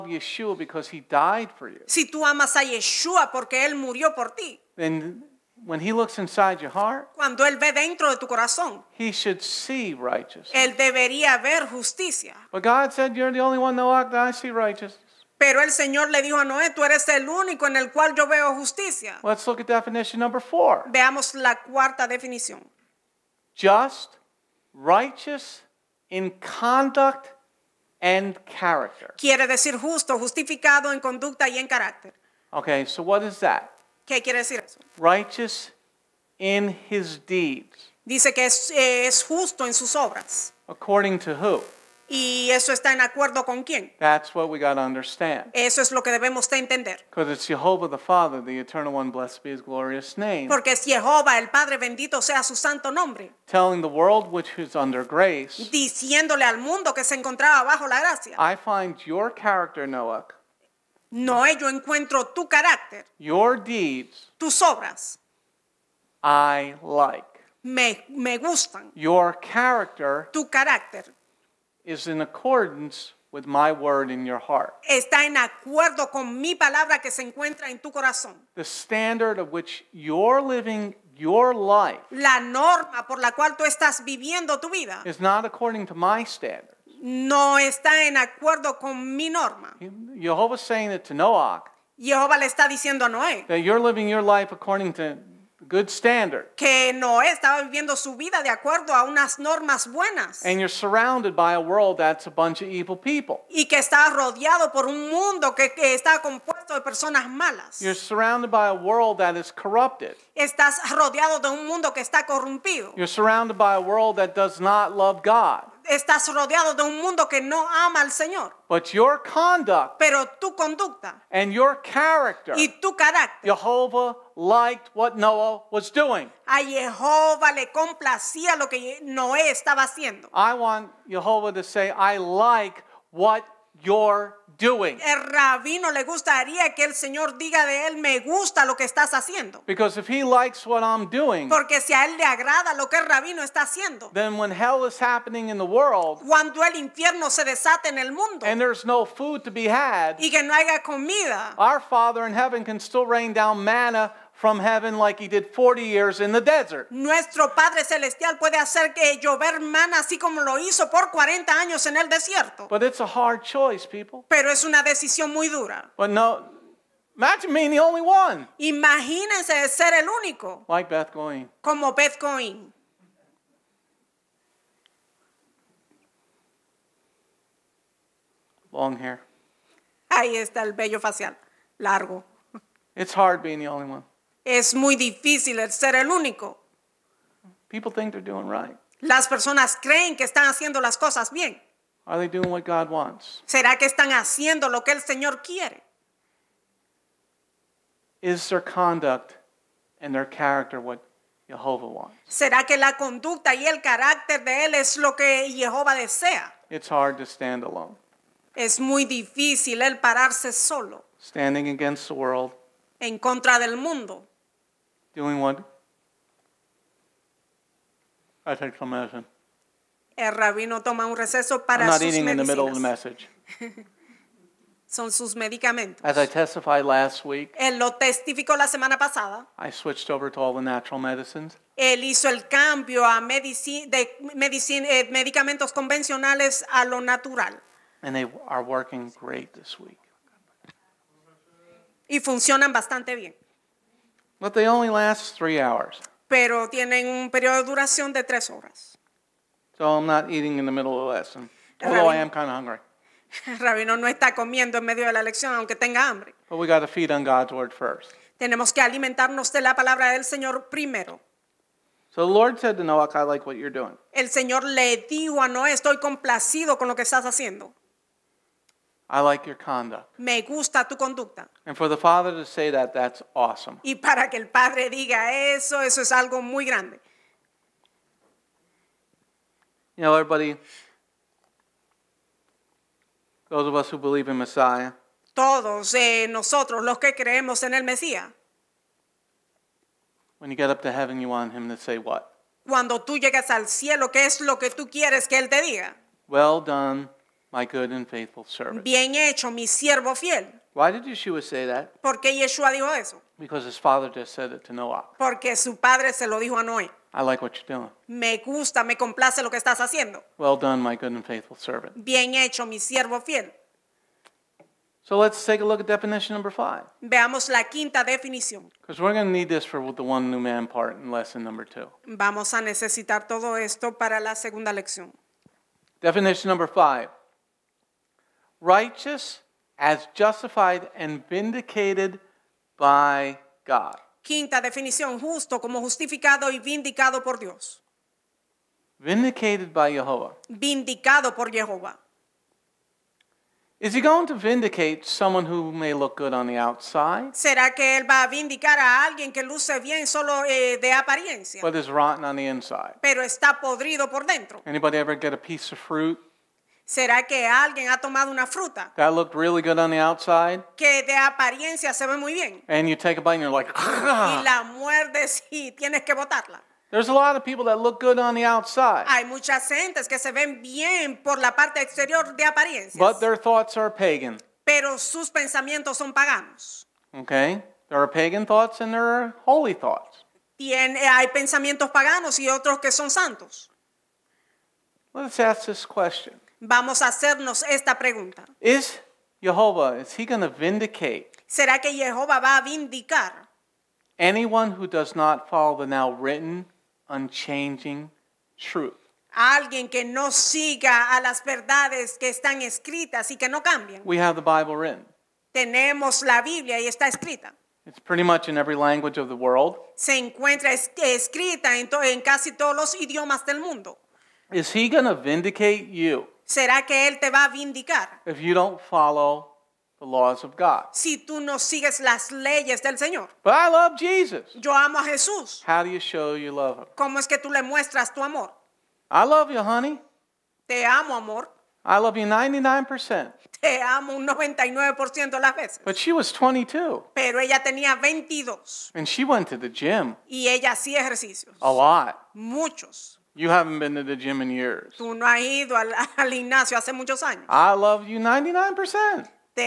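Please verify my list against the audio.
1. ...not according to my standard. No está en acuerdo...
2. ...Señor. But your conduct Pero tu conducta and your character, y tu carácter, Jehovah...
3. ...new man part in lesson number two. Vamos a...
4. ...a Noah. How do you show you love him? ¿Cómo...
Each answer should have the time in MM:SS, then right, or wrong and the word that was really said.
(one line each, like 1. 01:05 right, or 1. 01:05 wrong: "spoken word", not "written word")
1. 01:25 right
2. 01:58 right
3. 05:20 right
4. 07:04 wrong: "Jesús", not "Noah".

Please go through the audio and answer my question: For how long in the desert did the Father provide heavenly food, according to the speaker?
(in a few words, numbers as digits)
40 years.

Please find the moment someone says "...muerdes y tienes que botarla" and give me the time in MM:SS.
06:04.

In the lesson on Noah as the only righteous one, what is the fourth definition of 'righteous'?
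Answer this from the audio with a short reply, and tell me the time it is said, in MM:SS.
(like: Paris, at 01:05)
Righteous in conduct and character, at 00:24.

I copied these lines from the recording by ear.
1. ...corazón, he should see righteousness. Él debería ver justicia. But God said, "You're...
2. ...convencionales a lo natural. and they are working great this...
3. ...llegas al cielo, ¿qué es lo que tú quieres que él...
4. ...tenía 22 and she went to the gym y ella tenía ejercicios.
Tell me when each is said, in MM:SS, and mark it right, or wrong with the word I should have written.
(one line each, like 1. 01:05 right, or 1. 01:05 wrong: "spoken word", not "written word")
1. 00:08 right
2. 03:55 right
3. 04:53 right
4. 07:17 wrong: "hacía", not "tenía".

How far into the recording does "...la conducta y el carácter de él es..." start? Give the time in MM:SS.
03:22.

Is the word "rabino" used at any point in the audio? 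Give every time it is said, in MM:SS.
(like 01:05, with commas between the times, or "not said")
02:15, 02:23, 03:40, 04:13.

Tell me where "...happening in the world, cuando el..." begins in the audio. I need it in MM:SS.
02:25.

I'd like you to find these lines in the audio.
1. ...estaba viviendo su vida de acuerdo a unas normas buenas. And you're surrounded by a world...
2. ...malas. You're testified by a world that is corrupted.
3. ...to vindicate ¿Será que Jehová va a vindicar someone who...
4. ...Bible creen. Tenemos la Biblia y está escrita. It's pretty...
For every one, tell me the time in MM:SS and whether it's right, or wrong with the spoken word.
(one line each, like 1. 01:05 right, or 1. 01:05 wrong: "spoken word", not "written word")
1. 01:37 right
2. 01:47 wrong: "surrounded", not "testified"
3. 06:30 wrong: "anyone", not "someone"
4. 06:44 wrong: "written", not "creen".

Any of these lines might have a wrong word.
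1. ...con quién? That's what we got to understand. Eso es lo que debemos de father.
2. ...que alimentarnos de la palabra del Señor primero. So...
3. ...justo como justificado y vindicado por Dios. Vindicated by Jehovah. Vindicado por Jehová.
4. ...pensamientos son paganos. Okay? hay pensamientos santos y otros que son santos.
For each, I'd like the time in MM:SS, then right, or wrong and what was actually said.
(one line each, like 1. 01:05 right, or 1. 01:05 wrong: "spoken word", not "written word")
1. 00:43 wrong: "entender", not "father"
2. 04:18 right
3. 05:35 right
4. 06:15 wrong: "paganos", not "santos".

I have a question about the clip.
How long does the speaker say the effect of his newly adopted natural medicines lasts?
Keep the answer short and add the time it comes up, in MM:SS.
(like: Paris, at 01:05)
Three hours, at 04:05.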